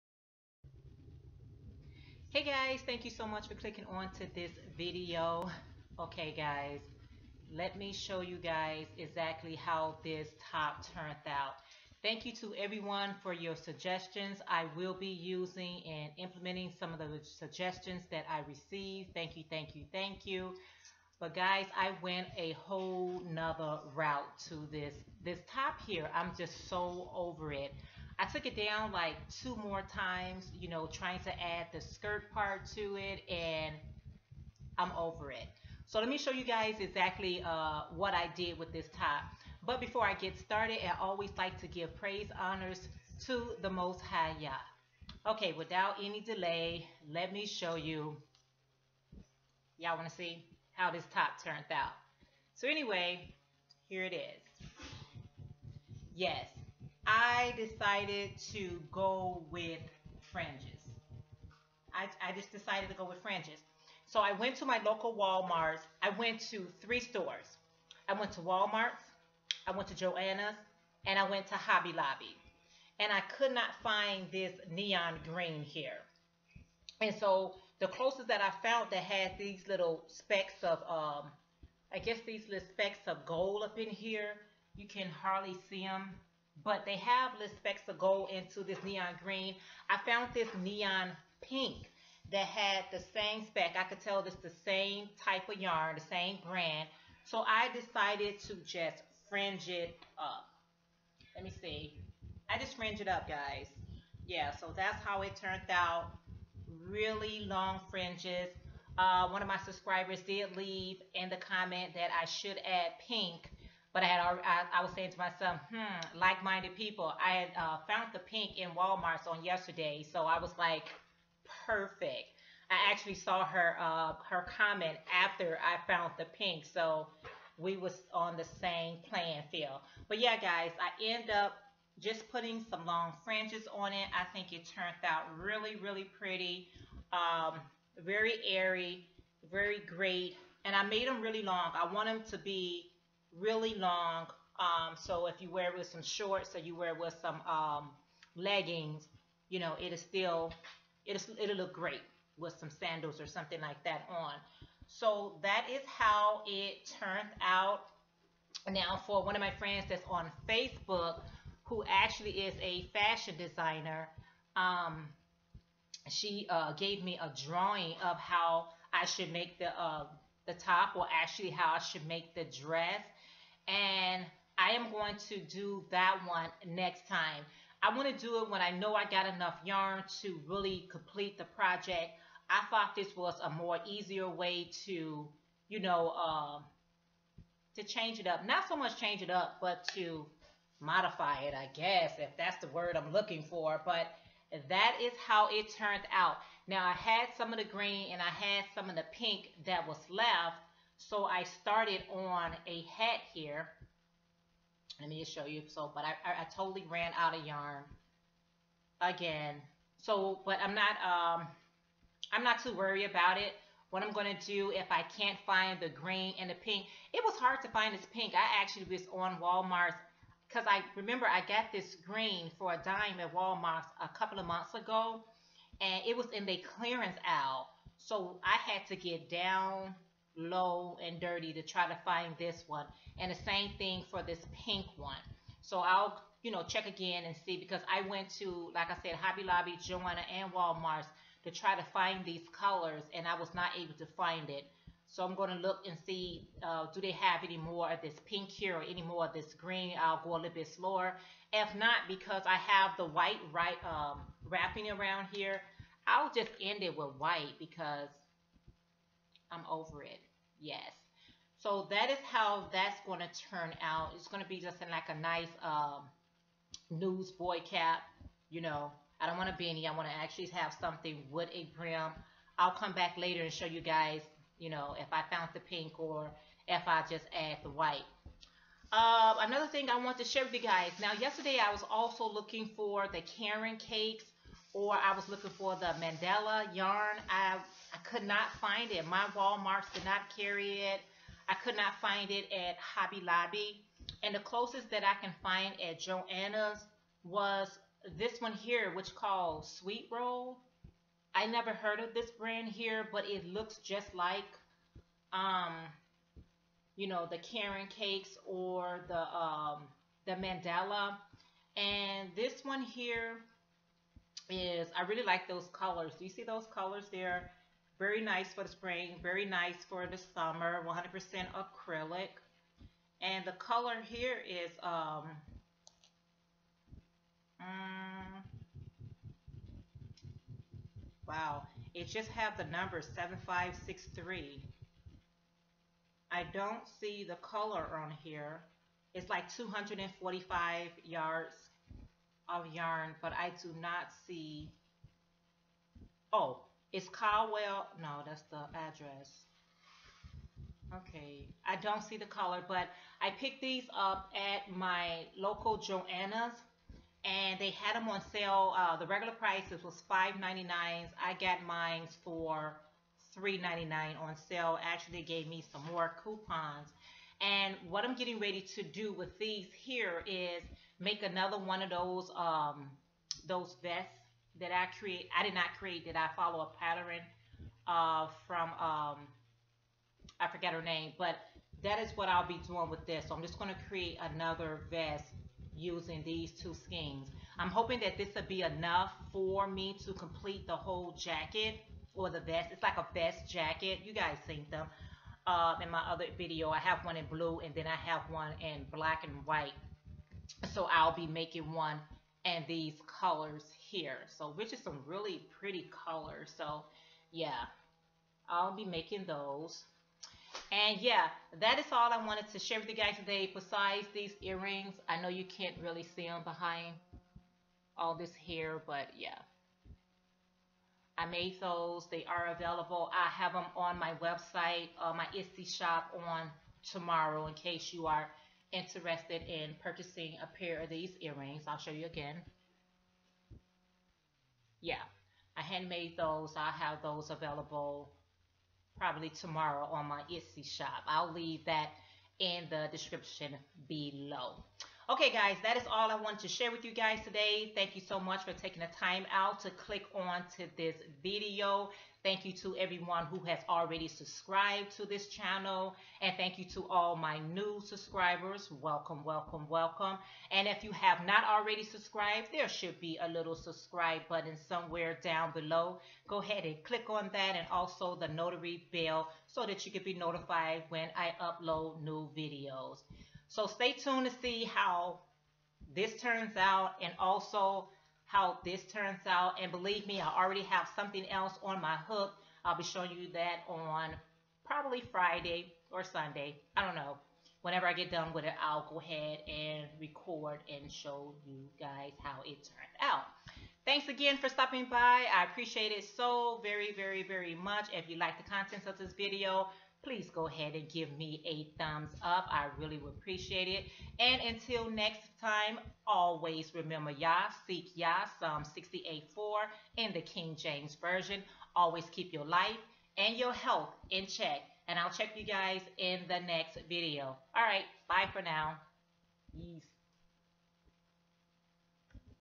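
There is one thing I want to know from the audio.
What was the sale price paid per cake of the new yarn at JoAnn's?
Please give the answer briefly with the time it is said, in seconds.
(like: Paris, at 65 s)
$3.99, at 363 s.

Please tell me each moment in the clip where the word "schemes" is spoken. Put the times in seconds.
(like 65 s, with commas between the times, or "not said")
386 s.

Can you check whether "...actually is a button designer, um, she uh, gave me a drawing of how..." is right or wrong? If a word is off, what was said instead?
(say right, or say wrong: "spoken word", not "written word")
wrong: "fashion", not "button".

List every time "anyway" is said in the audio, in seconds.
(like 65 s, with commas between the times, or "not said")
52 s.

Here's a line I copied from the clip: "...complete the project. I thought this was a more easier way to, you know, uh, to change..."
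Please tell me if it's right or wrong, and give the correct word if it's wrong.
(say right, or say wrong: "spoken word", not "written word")
right.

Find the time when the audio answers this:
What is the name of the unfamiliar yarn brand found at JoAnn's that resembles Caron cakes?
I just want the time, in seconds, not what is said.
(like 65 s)
299 s.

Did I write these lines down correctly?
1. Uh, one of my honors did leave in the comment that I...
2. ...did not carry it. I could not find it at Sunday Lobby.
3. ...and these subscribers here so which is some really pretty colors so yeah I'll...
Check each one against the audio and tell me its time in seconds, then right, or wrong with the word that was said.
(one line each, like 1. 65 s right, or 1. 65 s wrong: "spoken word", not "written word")
1. 108 s wrong: "subscribers", not "honors"
2. 289 s wrong: "Hobby", not "Sunday"
3. 402 s wrong: "colors", not "subscribers".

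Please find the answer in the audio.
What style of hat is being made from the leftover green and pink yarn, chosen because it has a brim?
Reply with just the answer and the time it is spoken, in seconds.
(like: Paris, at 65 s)
newsboy cap, at 266 s.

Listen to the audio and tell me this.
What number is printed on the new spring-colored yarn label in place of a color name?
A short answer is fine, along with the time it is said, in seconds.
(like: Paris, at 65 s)
7563, at 333 s.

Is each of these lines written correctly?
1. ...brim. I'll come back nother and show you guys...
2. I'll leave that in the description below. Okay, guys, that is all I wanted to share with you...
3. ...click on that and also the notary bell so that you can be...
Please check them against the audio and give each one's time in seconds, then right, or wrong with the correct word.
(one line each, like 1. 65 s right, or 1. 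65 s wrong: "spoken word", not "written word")
1. 271 s wrong: "later", not "nother"
2. 441 s right
3. 466 s right.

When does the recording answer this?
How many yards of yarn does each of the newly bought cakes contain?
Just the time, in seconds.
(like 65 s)
339 s.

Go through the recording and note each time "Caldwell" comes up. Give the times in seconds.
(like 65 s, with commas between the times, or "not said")
347 s.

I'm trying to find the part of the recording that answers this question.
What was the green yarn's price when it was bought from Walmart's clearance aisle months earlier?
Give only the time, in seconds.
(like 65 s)
222 s.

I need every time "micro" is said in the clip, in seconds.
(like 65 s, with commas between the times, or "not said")
not said.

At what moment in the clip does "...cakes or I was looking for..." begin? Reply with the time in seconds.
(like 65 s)
283 s.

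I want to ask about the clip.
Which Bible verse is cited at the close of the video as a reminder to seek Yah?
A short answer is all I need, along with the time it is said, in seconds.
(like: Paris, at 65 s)
Psalm 68:4, at 508 s.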